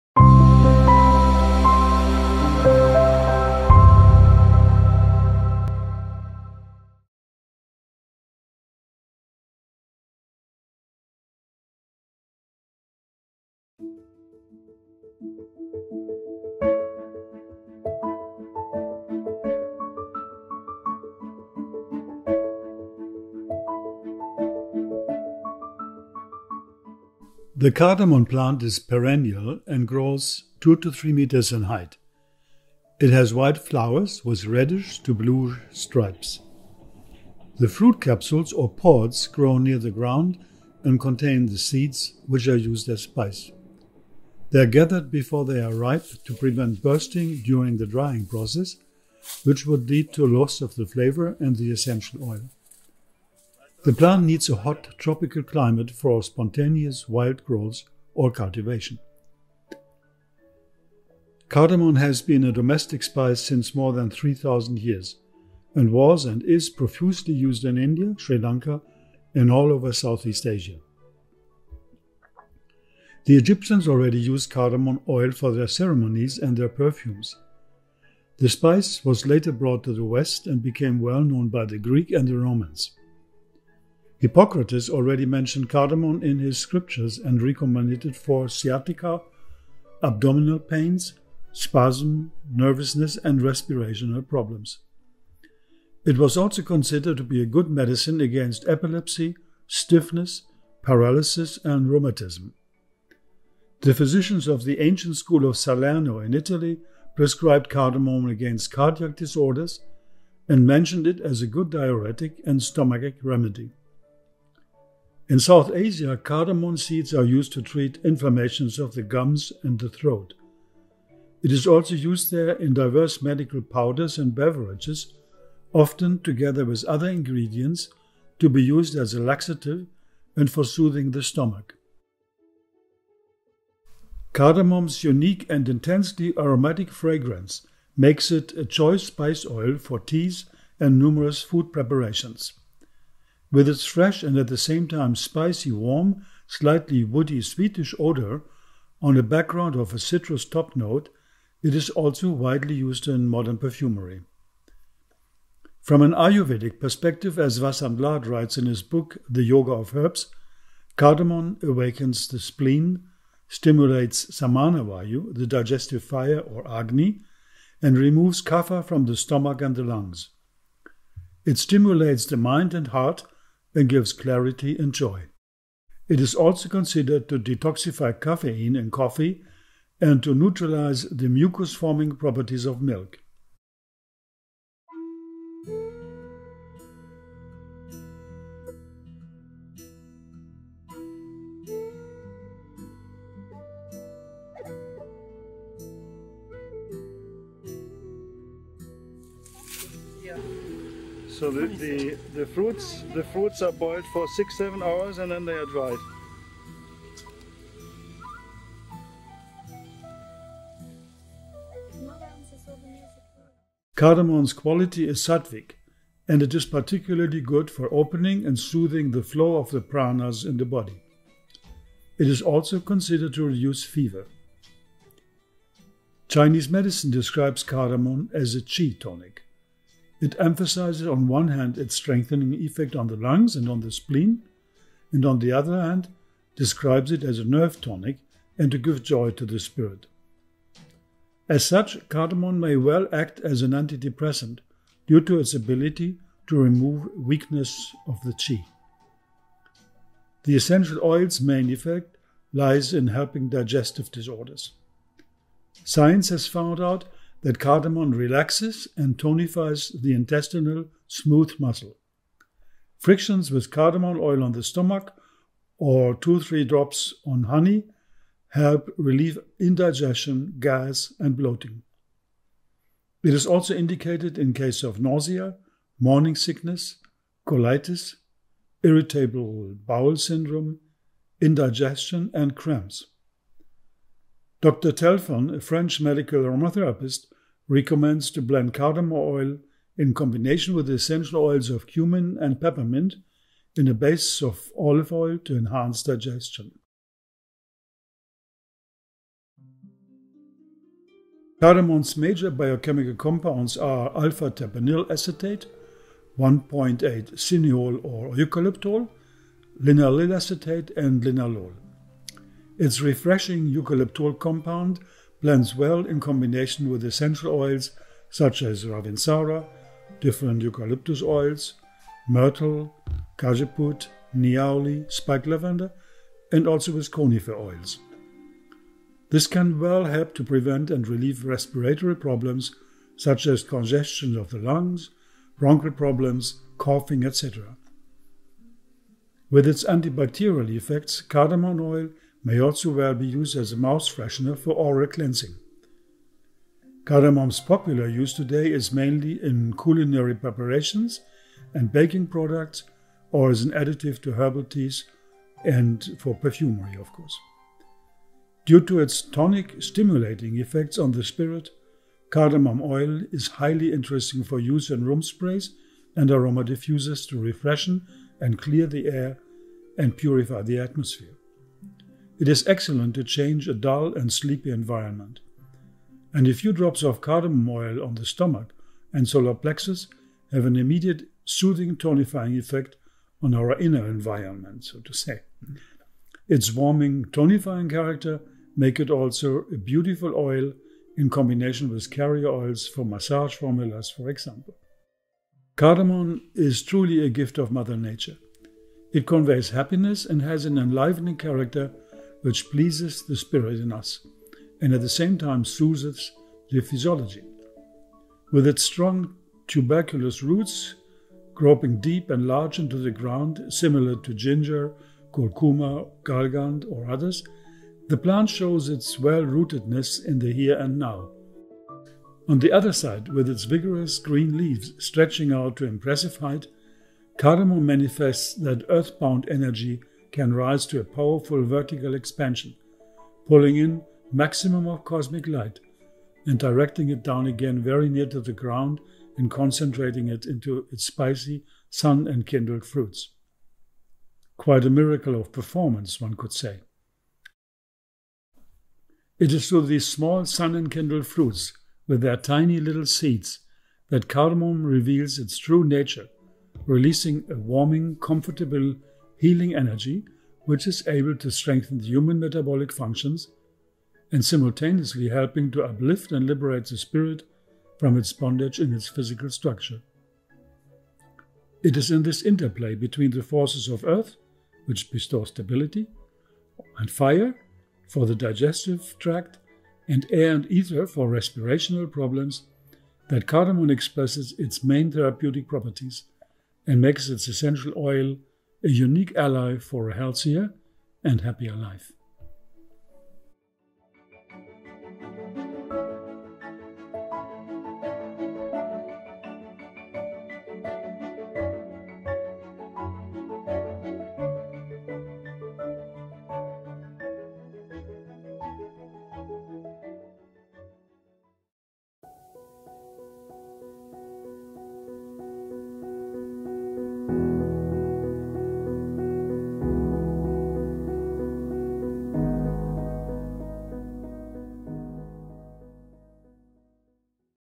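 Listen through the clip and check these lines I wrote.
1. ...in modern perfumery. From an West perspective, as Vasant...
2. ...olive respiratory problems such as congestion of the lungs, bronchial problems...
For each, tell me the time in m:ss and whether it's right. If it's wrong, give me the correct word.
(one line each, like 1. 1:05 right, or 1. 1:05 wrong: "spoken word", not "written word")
1. 2:33 wrong: "Ayurvedic", not "West"
2. 5:31 wrong: "relieve", not "olive".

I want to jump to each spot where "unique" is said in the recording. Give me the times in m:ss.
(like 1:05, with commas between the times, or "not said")
2:15, 8:08.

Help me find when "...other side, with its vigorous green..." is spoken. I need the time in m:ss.
7:02.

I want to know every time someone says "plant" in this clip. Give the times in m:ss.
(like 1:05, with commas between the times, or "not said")
0:28, 0:53, 6:58.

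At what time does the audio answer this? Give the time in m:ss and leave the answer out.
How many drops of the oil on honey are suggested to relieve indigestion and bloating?
4:26.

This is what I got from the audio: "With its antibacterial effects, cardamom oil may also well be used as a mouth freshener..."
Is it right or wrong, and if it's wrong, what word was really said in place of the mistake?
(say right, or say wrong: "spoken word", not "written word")
right.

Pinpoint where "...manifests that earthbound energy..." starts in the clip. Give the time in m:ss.
7:07.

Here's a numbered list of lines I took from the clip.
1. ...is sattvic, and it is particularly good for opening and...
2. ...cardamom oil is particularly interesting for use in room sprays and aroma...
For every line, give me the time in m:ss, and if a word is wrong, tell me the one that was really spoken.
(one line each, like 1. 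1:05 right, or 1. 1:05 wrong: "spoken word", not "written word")
1. 3:35 right
2. 6:02 wrong: "highly", not "particularly".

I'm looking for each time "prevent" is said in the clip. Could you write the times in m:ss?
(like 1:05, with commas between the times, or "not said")
0:46, 5:30.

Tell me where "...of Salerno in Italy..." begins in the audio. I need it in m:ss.
1:45.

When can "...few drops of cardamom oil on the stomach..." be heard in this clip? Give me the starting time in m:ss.
6:16.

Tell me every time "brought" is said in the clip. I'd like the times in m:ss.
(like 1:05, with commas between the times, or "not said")
1:19.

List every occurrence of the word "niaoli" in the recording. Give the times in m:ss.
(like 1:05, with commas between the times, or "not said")
5:24.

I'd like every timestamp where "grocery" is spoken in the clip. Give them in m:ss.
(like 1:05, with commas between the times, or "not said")
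not said.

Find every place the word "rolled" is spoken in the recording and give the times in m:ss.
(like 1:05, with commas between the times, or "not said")
not said.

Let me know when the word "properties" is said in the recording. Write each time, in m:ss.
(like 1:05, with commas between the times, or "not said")
3:02, 8:05.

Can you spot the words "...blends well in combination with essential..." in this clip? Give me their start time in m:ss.
5:15.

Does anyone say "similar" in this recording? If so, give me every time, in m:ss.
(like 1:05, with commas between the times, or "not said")
6:53.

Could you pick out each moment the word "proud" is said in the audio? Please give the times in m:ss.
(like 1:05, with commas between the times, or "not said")
not said.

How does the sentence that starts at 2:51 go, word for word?
It stimulates the mind and heart and gives clarity and joy.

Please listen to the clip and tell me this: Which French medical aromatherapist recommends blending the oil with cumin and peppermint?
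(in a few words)
Dr. Telfon.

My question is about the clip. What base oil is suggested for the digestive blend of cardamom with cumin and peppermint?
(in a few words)
olive oil.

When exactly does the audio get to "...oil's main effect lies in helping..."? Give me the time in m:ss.
4:11.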